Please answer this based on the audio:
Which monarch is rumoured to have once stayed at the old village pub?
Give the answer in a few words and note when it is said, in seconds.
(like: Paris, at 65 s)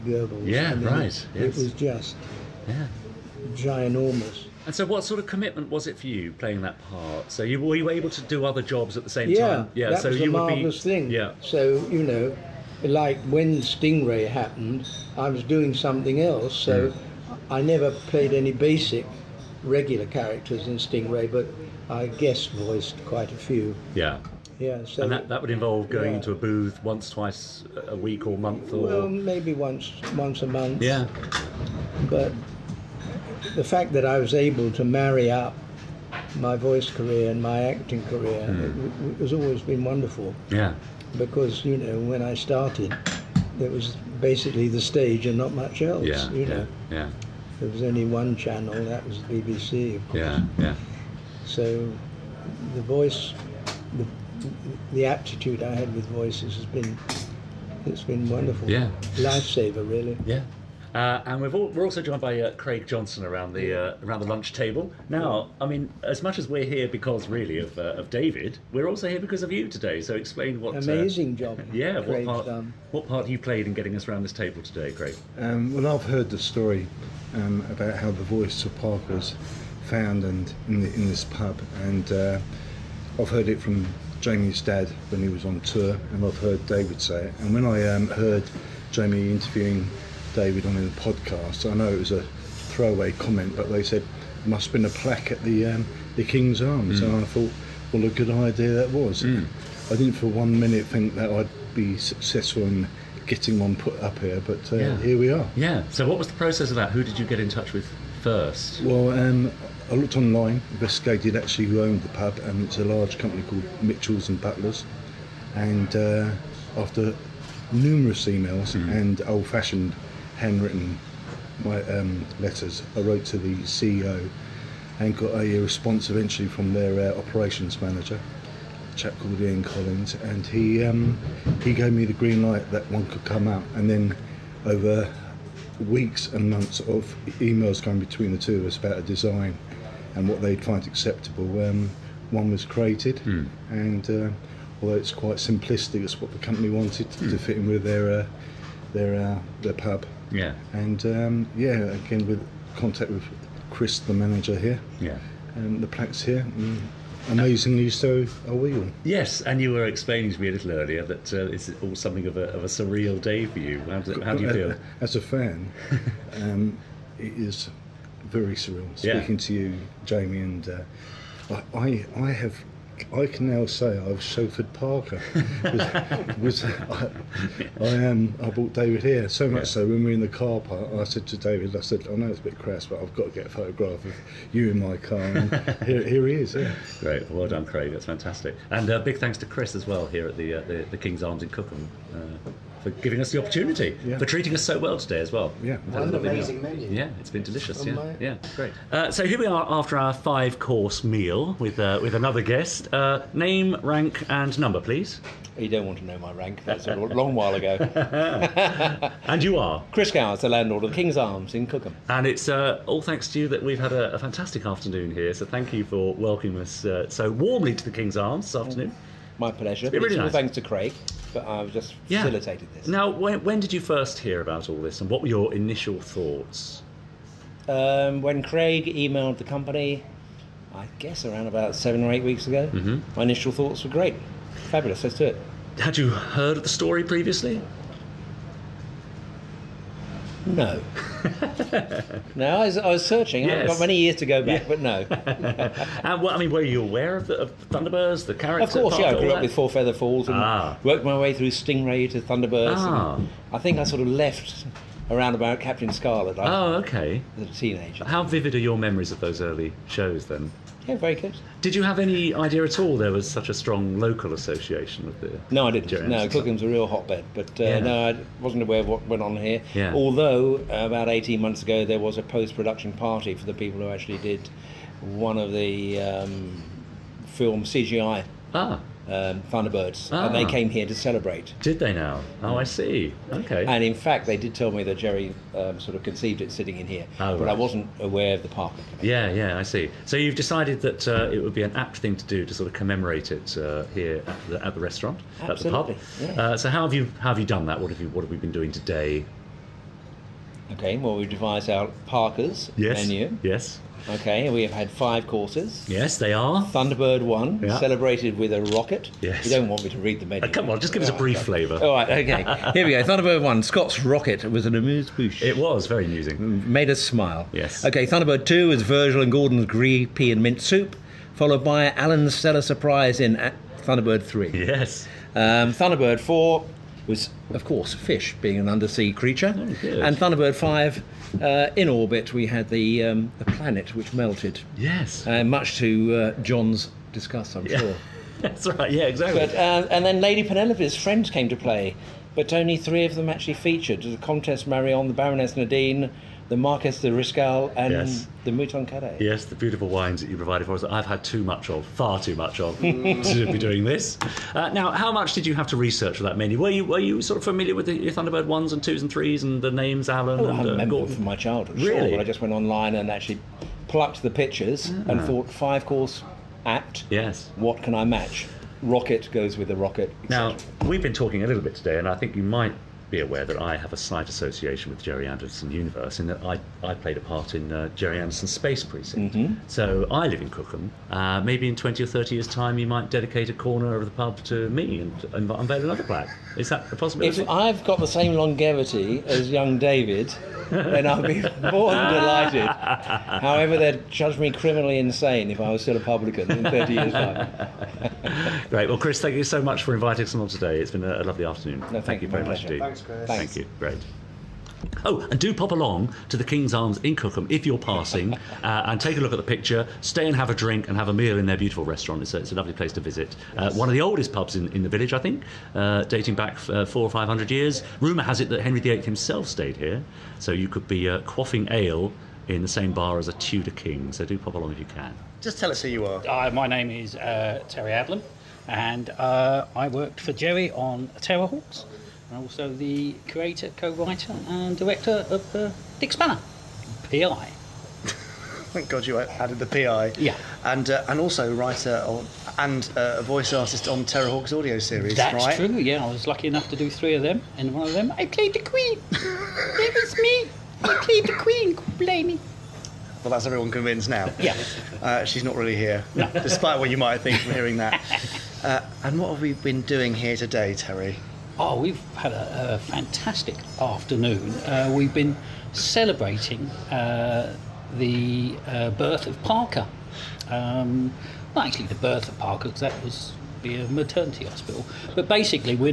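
Henry VIII, at 418 s.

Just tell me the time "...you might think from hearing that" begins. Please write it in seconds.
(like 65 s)
456 s.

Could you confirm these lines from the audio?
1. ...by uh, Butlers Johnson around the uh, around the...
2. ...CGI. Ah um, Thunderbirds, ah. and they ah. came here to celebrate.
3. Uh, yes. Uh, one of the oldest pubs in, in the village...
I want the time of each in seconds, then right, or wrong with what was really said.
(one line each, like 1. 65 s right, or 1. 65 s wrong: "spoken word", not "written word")
1. 62 s wrong: "Craig", not "Butlers"
2. 277 s right
3. 413 s right.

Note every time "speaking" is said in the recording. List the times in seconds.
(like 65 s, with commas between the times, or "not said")
168 s.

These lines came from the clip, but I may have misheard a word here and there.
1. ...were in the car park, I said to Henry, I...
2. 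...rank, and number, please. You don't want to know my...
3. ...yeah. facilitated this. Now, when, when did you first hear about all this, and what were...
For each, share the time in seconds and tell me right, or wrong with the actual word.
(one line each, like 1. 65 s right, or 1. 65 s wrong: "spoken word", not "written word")
1. 180 s wrong: "David", not "Henry"
2. 203 s right
3. 222 s right.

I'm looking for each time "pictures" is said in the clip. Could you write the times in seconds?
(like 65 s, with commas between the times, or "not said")
364 s, 409 s.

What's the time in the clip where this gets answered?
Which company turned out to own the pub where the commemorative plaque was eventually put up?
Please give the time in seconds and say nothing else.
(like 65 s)
113 s.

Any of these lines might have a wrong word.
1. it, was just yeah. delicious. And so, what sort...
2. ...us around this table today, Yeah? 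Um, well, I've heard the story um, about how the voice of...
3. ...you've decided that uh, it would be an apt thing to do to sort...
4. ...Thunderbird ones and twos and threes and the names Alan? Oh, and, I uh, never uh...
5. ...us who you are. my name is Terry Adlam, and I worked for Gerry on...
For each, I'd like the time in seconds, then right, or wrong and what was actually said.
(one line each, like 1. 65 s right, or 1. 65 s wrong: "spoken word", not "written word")
1. 1 s wrong: "ginormous", not "delicious"
2. 73 s wrong: "Craig", not "Yeah"
3. 290 s right
4. 358 s wrong: "remember", not "never"
5. 425 s right.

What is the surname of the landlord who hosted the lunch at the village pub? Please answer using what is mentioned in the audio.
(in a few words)
Gowers.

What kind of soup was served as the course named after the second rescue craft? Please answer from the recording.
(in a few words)
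Green pea and mint.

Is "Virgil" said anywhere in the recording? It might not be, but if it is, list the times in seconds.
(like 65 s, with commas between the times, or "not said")
318 s.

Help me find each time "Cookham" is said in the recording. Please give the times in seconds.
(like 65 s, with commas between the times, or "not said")
191 s, 211 s, 266 s, 380 s, 407 s.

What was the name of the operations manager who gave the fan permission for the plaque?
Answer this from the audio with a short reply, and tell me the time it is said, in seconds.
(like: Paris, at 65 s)
Ian Collins, at 129 s.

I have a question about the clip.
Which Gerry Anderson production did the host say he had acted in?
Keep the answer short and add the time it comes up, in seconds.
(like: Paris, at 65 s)
Space Precinct, at 378 s.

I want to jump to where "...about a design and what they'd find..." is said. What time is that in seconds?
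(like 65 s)
138 s.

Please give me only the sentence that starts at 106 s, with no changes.
Who did you get in touch with first?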